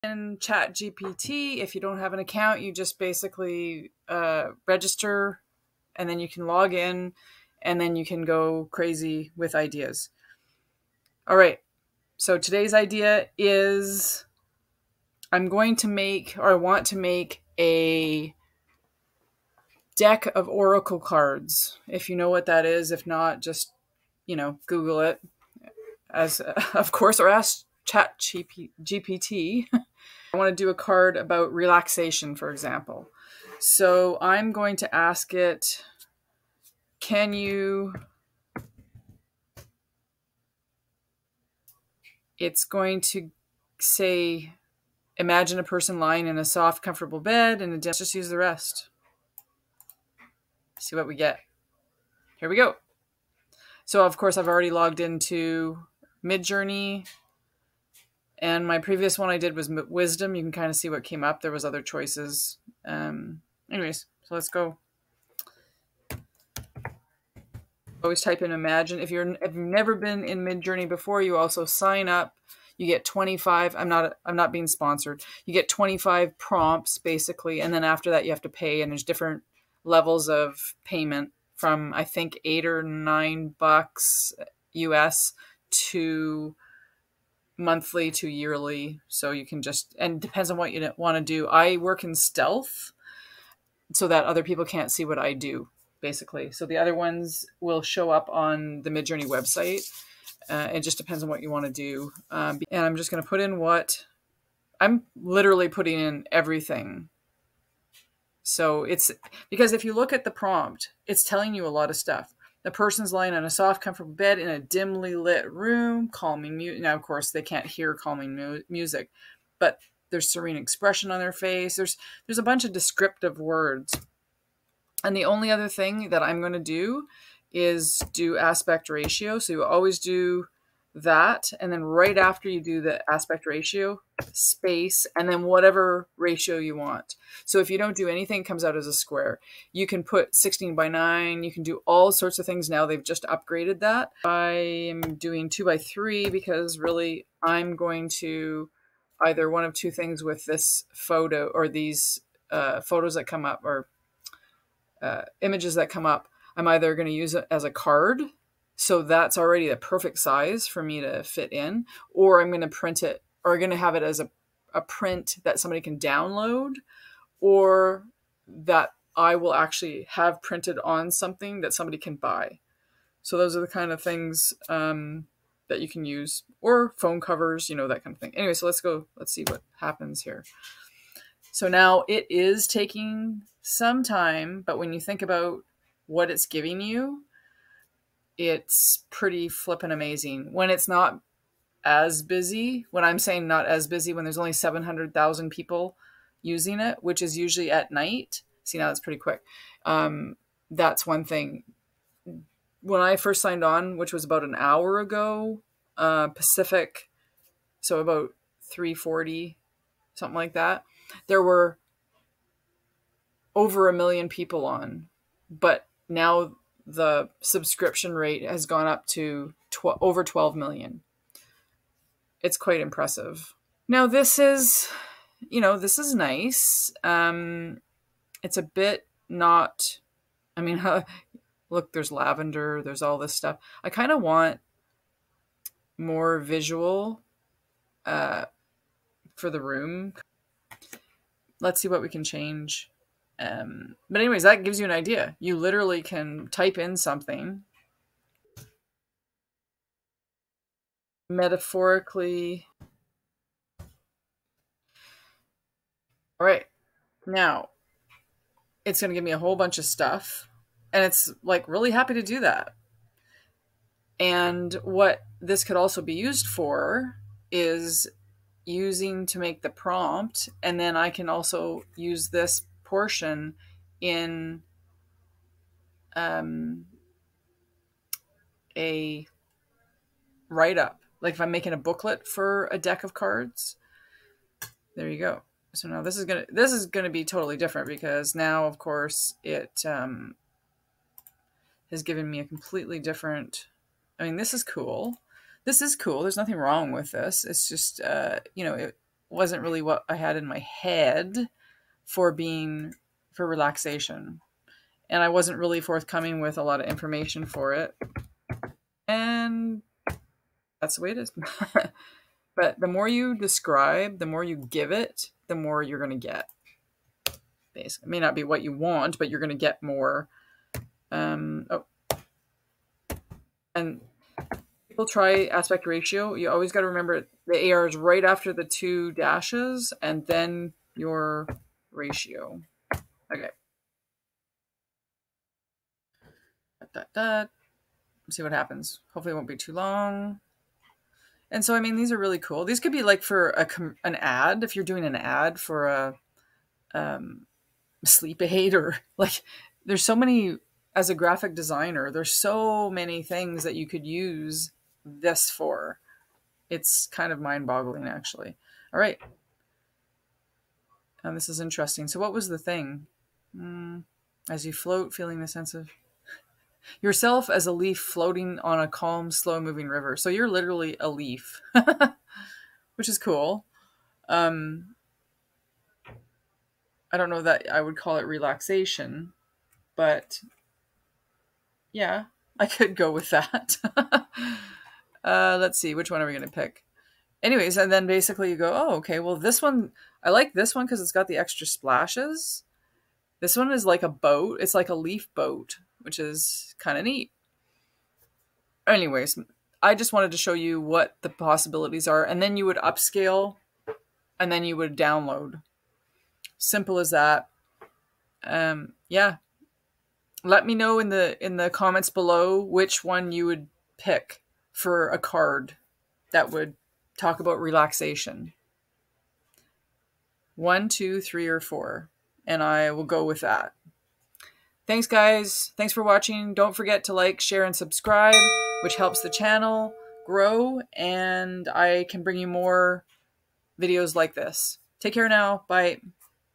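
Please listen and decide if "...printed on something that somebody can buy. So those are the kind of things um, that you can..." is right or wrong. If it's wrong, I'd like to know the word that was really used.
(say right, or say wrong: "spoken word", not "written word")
right.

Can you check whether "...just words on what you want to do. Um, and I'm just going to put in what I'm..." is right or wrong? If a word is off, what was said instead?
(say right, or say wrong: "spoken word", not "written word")
wrong: "depends", not "words".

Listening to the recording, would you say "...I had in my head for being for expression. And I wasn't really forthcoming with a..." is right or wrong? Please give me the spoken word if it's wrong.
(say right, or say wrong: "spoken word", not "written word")
wrong: "relaxation", not "expression".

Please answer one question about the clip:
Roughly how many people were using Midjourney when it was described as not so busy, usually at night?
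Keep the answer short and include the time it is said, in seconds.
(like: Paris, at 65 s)
700,000, at 194 s.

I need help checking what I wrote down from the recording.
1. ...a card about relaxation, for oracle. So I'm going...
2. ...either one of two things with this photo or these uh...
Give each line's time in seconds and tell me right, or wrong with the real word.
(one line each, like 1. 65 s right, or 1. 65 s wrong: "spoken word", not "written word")
1. 30 s wrong: "example", not "oracle"
2. 149 s right.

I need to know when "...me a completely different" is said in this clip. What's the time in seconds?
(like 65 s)
292 s.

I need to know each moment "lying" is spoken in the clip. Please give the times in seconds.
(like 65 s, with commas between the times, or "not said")
45 s, 113 s.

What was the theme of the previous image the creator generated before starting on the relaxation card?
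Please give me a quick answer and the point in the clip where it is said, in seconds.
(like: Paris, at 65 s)
Wisdom, at 59 s.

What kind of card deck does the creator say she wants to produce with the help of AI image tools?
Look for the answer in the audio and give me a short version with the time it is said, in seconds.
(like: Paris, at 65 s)
Oracle cards, at 20 s.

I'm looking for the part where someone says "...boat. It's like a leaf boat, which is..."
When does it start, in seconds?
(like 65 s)
394 s.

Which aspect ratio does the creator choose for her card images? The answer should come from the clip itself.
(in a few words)
2 by 3.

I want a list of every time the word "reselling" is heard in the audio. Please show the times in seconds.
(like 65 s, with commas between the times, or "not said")
not said.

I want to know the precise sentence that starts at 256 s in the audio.
All right, now it's going to give me a whole bunch of stuff.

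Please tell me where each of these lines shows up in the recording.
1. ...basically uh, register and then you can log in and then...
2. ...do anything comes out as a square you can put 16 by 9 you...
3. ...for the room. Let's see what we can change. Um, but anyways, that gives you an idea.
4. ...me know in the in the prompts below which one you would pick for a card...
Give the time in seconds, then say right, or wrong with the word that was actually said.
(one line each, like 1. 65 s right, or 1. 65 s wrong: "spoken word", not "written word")
1. 2 s right
2. 137 s right
3. 239 s right
4. 410 s wrong: "comments", not "prompts".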